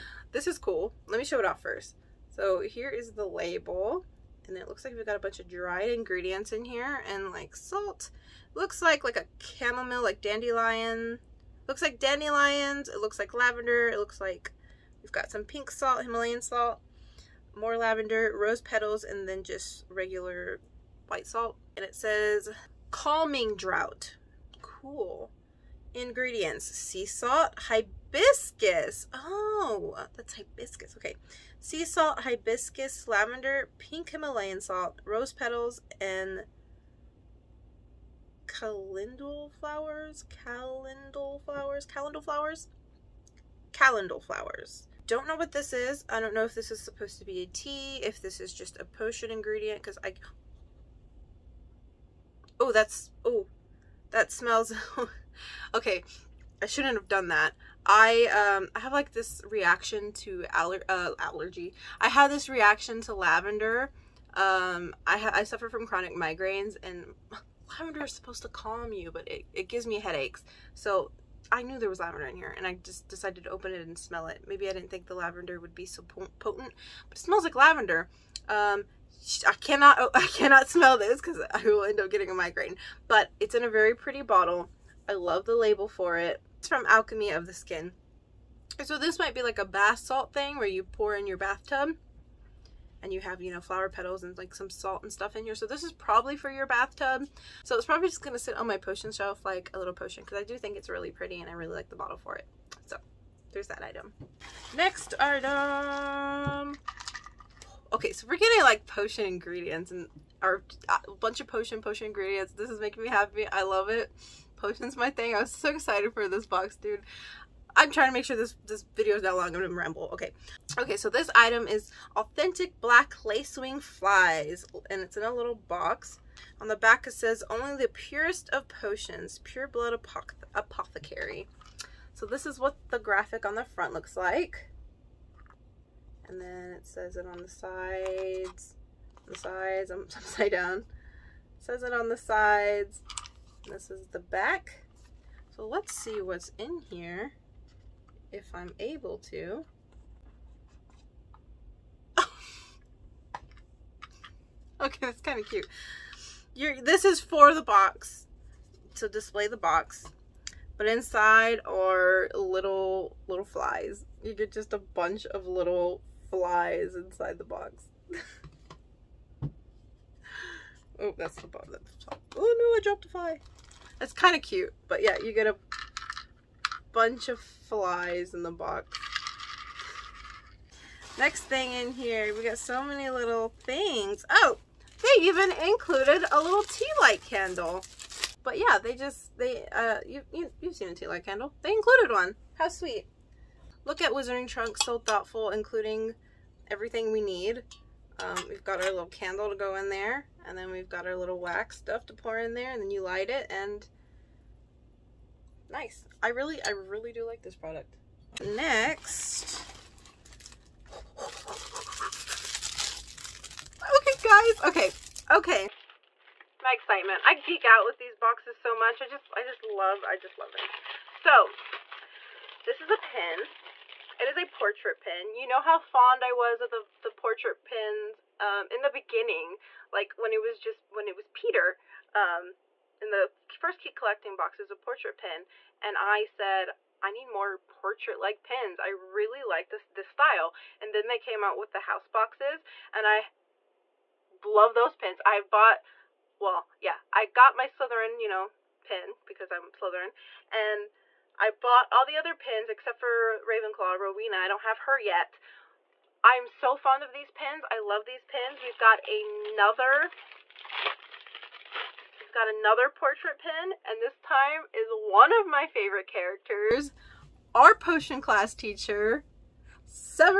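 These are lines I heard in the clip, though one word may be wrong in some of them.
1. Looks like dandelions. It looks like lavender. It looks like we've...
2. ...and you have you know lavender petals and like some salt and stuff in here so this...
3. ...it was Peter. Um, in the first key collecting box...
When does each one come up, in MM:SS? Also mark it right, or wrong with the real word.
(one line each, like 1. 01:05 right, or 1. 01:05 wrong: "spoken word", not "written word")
1. 00:11 right
2. 01:33 wrong: "flower", not "lavender"
3. 03:51 right.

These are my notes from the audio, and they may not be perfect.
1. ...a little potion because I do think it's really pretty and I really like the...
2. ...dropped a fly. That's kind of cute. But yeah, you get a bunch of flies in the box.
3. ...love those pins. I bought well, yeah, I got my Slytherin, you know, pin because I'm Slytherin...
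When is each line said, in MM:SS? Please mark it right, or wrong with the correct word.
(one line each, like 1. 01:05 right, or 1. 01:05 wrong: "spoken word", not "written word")
1. 01:39 right
2. 02:52 right
3. 04:04 right.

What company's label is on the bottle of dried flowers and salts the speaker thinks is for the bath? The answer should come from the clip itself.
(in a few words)
Alchemy of the Skin.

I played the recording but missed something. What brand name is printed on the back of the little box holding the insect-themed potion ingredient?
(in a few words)
Pure Blood Apothecary.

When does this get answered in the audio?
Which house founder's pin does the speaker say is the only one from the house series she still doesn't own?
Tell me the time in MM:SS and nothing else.
04:13.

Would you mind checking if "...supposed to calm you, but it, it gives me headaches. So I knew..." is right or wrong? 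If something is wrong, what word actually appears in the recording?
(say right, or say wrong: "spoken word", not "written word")
right.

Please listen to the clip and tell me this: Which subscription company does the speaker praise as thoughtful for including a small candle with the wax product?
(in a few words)
Wizarding Trunk.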